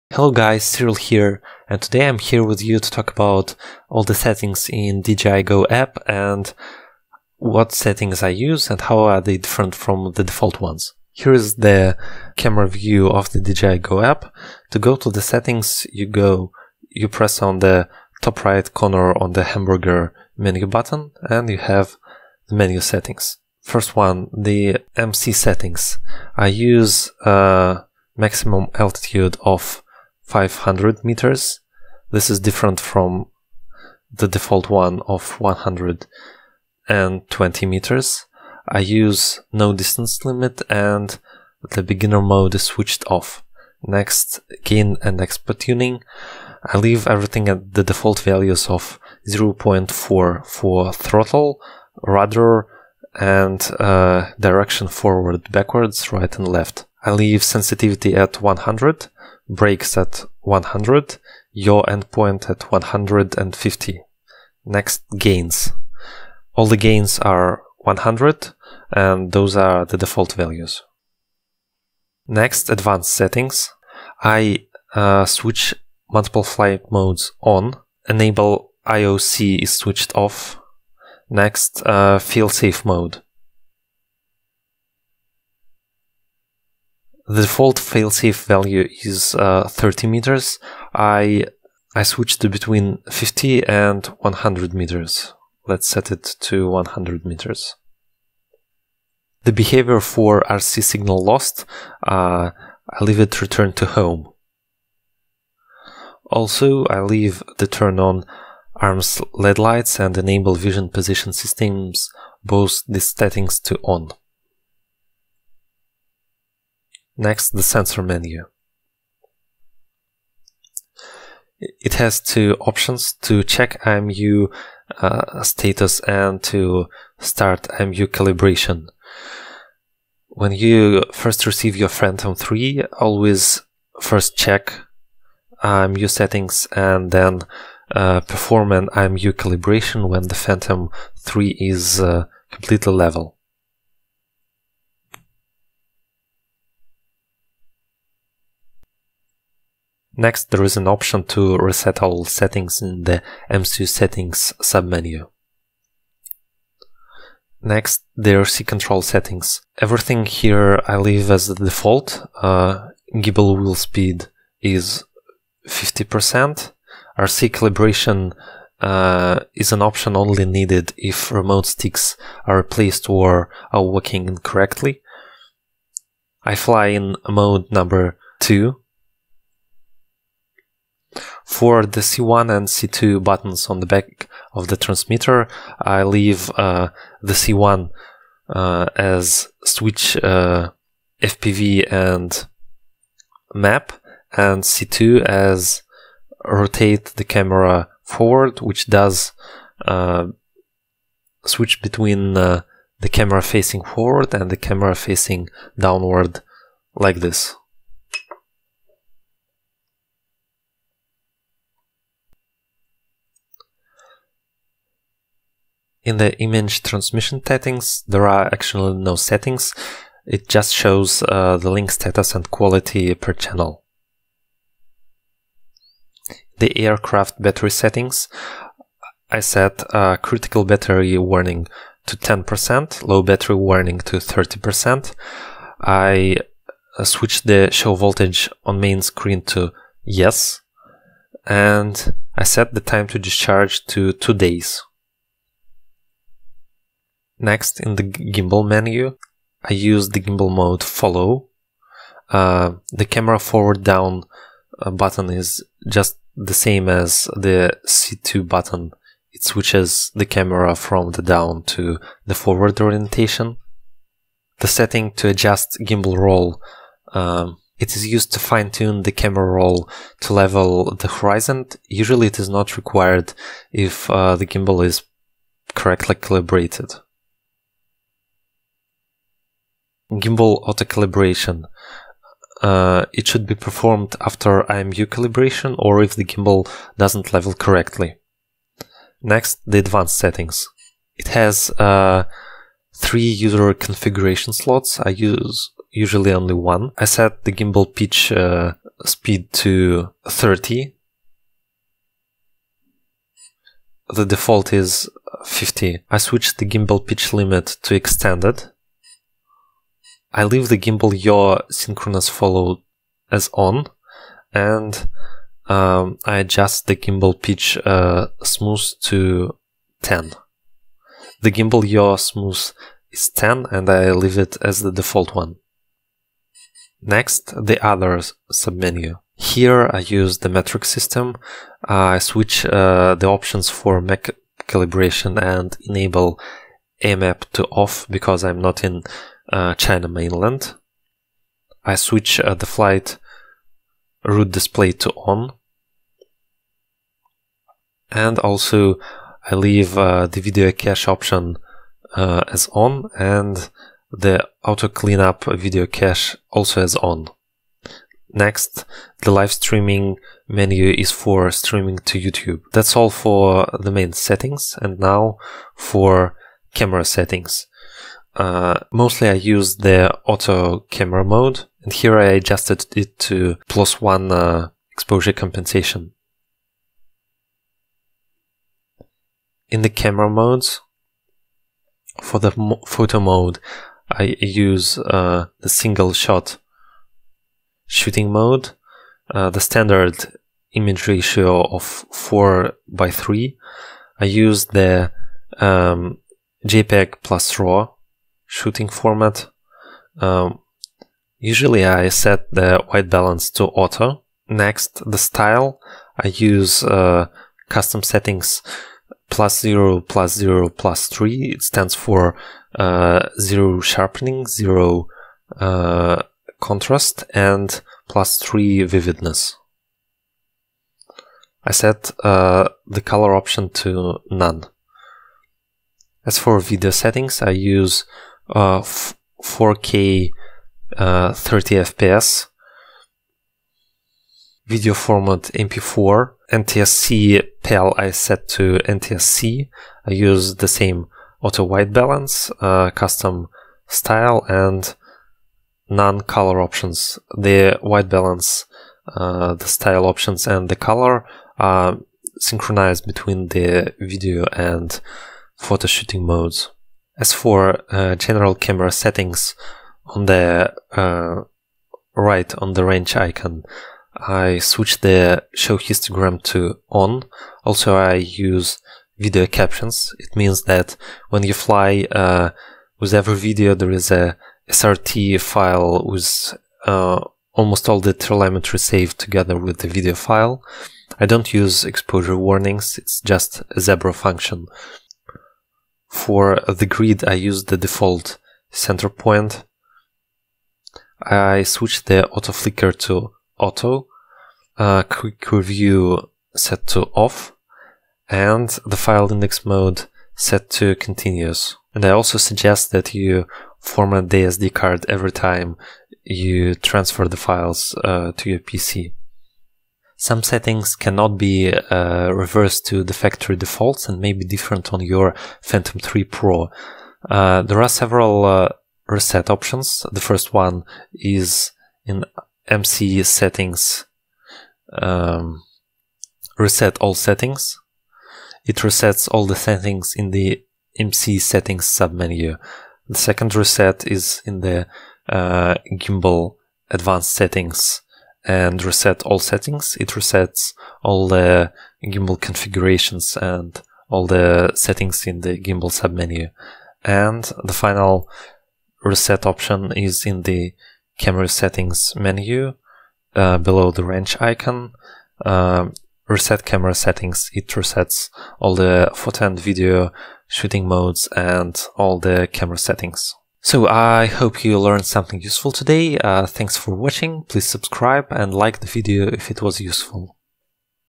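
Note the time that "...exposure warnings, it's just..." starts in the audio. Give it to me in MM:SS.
08:01.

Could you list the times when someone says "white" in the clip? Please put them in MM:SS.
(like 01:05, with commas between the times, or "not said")
06:42, 07:21, 07:27.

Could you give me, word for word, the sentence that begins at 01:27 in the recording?
the default failsafe value is uh, 30 meters.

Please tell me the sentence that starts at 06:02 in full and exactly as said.
That's all for the main settings and now for camera settings.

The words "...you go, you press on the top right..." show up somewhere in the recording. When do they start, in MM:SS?
00:15.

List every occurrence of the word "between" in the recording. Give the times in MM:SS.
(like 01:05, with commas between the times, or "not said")
01:32, 03:21, 07:33.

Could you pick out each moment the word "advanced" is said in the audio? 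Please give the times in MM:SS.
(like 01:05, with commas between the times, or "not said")
01:12, 04:49, 08:56.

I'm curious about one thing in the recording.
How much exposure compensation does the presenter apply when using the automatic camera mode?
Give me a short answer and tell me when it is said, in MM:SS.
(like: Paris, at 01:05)
plus one, at 06:13.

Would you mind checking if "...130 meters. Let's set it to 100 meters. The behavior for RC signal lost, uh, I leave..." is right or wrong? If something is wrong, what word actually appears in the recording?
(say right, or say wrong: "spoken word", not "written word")
wrong: "100", not "130".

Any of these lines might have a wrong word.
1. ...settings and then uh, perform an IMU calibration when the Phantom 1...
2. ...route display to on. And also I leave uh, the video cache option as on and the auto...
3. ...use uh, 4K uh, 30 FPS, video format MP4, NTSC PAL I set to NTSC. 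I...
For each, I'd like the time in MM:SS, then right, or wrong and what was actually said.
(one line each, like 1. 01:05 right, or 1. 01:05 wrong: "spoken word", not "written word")
1. 02:16 wrong: "3", not "1"
2. 05:44 right
3. 07:07 right.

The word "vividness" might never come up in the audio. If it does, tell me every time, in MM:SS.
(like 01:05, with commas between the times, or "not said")
06:58.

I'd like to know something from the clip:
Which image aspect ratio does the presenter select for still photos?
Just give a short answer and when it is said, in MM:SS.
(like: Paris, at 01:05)
4 by 3, at 06:31.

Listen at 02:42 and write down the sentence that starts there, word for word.
Uh, gimbal wheel speed is 50%.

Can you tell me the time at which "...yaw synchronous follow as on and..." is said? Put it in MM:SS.
05:11.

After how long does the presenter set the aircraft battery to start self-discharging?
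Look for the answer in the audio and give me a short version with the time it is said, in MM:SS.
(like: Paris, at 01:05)
two days, at 04:04.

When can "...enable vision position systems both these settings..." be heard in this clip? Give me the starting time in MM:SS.
01:50.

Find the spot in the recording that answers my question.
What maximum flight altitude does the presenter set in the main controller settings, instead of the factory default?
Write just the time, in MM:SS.
00:30.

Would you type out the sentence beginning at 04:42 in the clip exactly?
Uh, it should be performed after IMU calibration or if the gimbal doesn't level correctly.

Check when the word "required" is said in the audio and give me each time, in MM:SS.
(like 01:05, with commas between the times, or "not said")
04:32.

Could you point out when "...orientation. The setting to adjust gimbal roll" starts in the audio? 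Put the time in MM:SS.
04:22.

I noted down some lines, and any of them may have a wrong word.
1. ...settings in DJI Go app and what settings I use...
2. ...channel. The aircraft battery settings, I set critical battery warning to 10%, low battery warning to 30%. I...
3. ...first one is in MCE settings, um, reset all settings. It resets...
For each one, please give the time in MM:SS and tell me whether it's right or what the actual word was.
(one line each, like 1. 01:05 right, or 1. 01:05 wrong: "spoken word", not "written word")
1. 00:04 right
2. 03:43 right
3. 08:40 right.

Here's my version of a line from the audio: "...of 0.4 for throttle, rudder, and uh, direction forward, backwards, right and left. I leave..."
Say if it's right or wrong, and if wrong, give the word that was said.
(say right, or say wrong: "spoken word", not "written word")
right.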